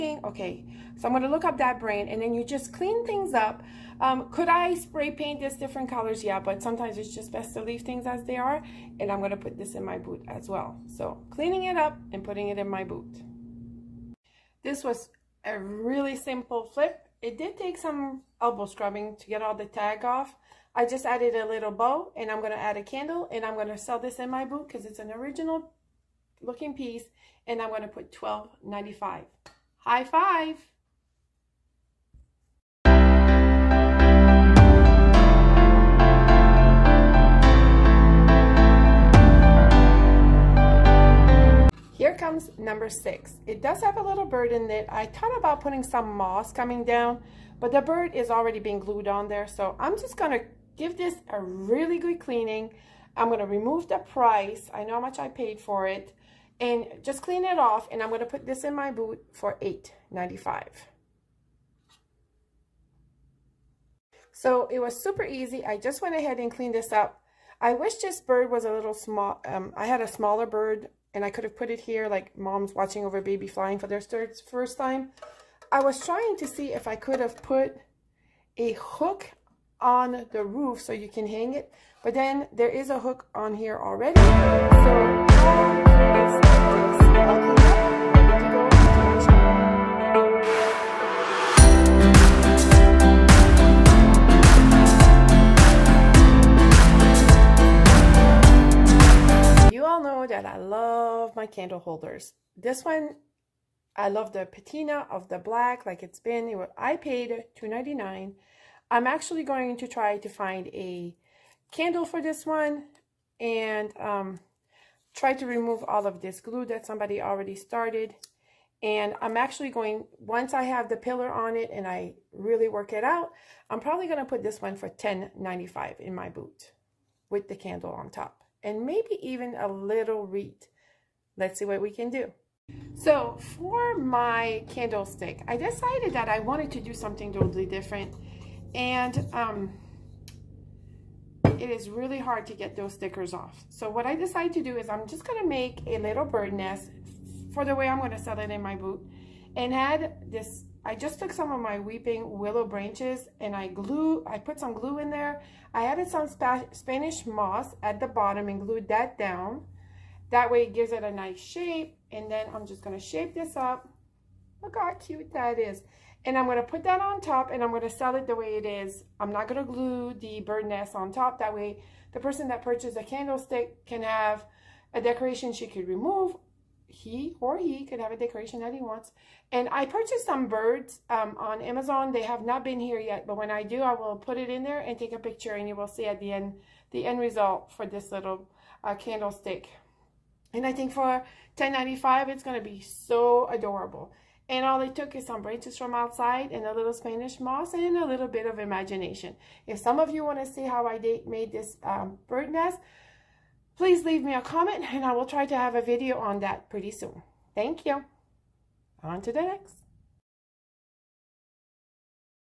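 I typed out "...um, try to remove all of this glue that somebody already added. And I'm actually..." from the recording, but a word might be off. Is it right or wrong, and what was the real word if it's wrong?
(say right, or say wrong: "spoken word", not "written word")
wrong: "started", not "added".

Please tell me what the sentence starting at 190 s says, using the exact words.
And I think for 10.95, it's going to be so adorable.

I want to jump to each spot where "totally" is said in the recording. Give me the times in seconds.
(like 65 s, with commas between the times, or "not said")
137 s.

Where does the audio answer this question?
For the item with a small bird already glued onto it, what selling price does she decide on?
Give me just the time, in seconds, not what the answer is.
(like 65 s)
59 s.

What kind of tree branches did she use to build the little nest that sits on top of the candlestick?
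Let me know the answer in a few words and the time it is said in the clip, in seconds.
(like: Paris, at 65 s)
Weeping willow, at 151 s.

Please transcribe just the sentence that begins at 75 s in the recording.
I was trying to see if I could have put a hook on the roof so you can hang it.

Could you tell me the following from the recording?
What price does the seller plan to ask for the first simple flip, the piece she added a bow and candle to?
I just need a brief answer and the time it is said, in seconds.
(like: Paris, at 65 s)
$12.95, at 28 s.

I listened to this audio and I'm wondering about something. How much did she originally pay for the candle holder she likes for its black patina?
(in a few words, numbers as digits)
$2.99.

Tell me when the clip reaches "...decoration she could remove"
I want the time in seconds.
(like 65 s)
174 s.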